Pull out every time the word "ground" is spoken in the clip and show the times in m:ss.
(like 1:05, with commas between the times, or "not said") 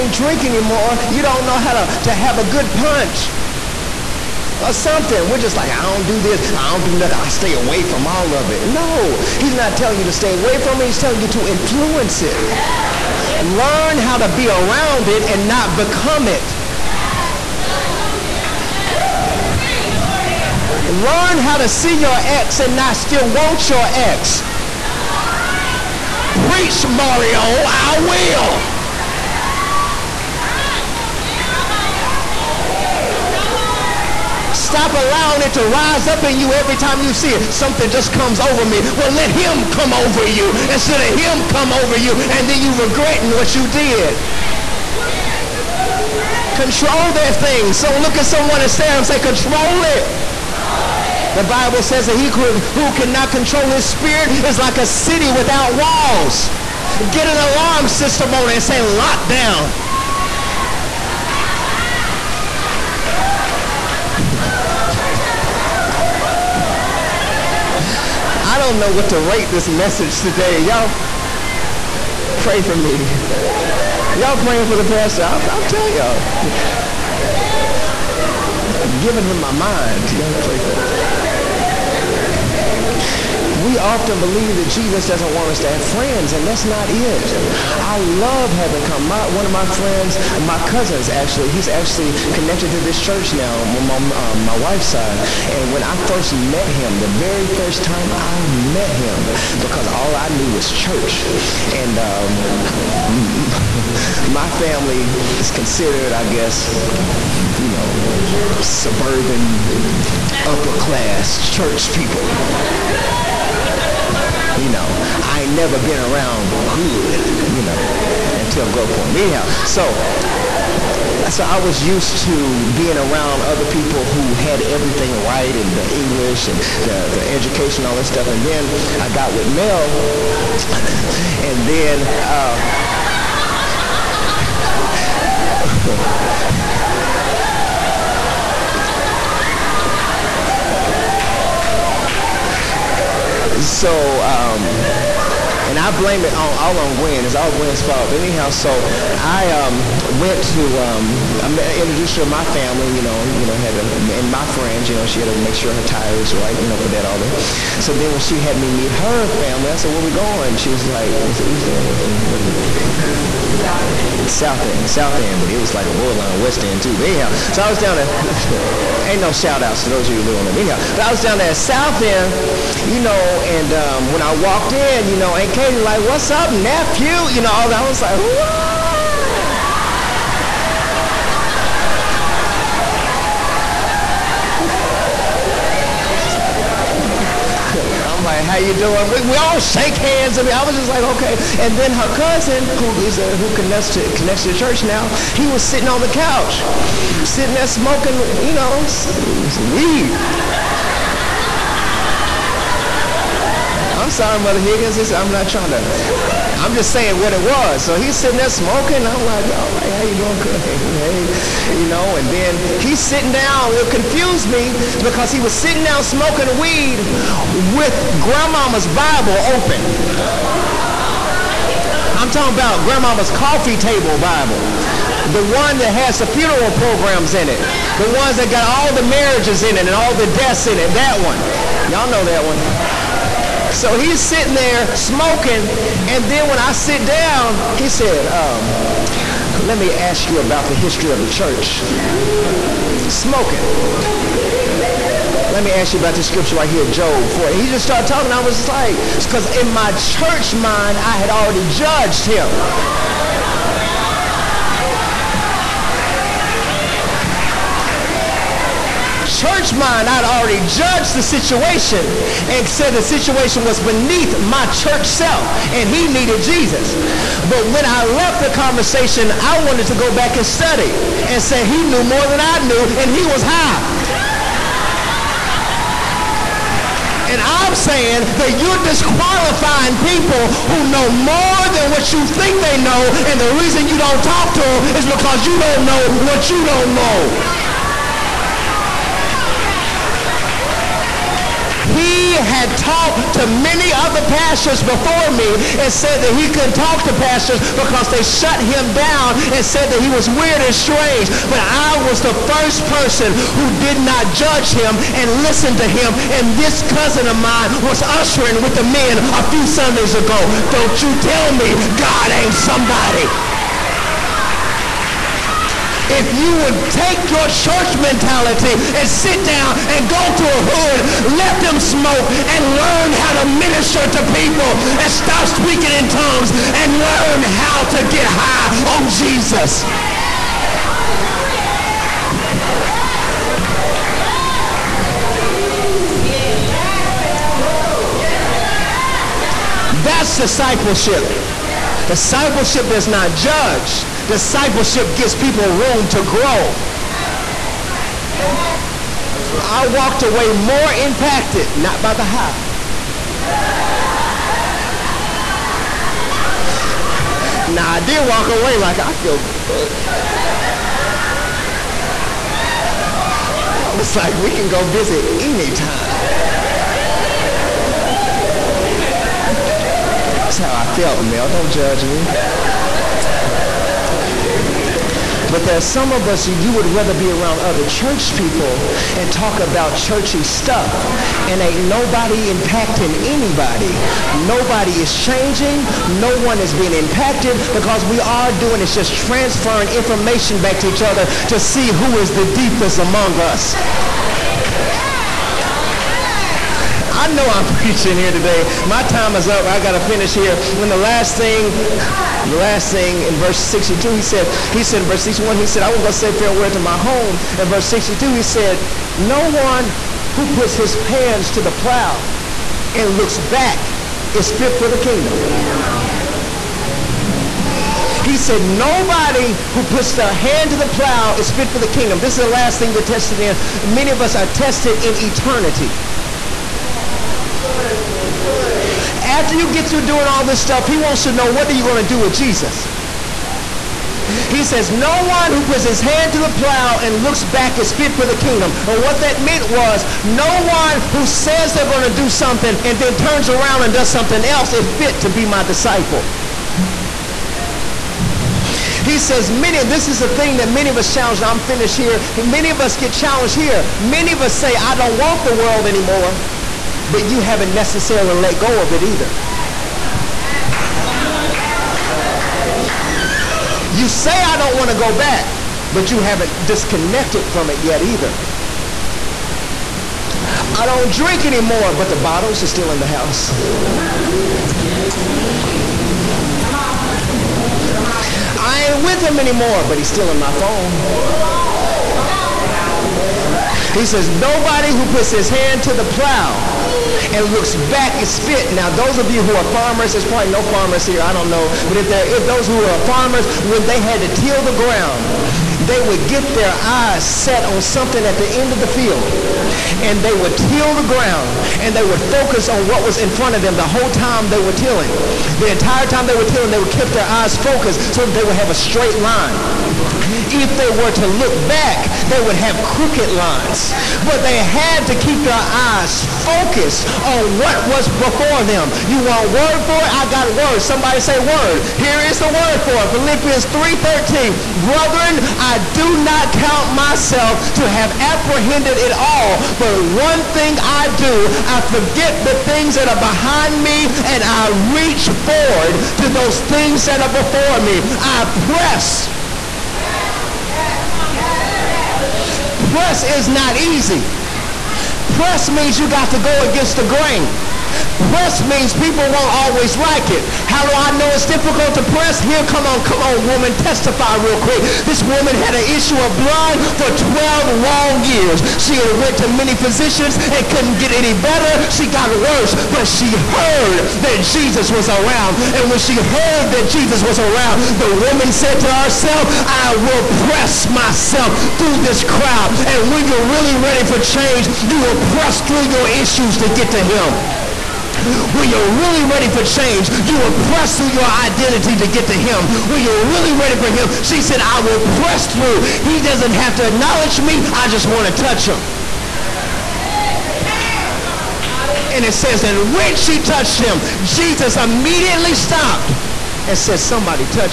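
8:14, 8:21.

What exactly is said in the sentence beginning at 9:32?
And when you're really ready for change, you will press through your issues to get to him.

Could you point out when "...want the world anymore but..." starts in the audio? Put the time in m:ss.
7:35.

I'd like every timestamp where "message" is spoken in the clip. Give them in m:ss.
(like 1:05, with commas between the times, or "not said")
1:09.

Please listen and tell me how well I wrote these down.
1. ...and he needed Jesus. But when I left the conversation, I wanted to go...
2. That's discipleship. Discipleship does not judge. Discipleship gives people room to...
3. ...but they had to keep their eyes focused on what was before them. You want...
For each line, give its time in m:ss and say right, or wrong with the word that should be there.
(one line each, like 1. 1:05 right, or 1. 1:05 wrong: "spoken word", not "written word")
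1. 4:25 right
2. 5:39 right
3. 8:34 right.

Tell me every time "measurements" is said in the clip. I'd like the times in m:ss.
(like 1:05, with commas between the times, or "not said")
not said.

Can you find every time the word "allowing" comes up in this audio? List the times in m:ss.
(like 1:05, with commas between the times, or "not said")
0:34.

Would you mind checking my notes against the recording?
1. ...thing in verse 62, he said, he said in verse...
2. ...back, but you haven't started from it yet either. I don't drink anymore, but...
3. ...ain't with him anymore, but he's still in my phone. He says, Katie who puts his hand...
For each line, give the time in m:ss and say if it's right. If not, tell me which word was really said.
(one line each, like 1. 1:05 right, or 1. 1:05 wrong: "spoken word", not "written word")
1. 6:42 right
2. 7:45 wrong: "disconnected", not "started"
3. 7:58 wrong: "Nobody", not "Katie".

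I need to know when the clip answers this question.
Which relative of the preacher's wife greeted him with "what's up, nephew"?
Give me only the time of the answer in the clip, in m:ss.
2:55.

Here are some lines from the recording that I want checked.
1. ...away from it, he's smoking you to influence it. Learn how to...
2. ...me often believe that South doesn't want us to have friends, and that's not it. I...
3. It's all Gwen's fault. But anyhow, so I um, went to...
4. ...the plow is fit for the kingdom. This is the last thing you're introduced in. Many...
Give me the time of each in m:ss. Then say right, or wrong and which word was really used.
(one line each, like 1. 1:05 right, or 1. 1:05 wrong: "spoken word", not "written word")
1. 0:10 wrong: "telling", not "smoking"
2. 1:20 wrong: "Jesus", not "South"
3. 2:27 right
4. 7:00 wrong: "tested", not "introduced".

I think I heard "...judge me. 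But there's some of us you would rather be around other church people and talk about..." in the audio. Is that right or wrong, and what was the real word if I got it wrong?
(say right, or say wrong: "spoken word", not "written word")
right.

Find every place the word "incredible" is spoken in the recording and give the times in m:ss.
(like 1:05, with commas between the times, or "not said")
not said.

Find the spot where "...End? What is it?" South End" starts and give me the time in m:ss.
2:42.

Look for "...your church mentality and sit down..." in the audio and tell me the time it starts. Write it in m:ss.
5:17.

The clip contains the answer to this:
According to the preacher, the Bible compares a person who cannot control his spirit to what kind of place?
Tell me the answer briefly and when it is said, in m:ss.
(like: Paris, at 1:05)
A city without walls, at 0:54.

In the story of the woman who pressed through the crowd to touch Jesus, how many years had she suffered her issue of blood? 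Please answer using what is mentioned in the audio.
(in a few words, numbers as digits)
12.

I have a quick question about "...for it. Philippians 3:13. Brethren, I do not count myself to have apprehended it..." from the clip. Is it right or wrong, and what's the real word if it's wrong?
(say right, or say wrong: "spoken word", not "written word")
right.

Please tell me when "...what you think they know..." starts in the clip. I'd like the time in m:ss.
4:41.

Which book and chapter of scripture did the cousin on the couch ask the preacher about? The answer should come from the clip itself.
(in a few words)
Job 4.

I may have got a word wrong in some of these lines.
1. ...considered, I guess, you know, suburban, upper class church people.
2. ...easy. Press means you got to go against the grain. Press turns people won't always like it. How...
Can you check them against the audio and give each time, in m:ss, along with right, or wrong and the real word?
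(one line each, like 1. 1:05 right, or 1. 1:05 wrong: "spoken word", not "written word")
1. 1:45 right
2. 9:03 wrong: "means", not "turns".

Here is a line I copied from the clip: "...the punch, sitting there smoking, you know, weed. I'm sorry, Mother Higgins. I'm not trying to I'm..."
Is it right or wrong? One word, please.
wrong.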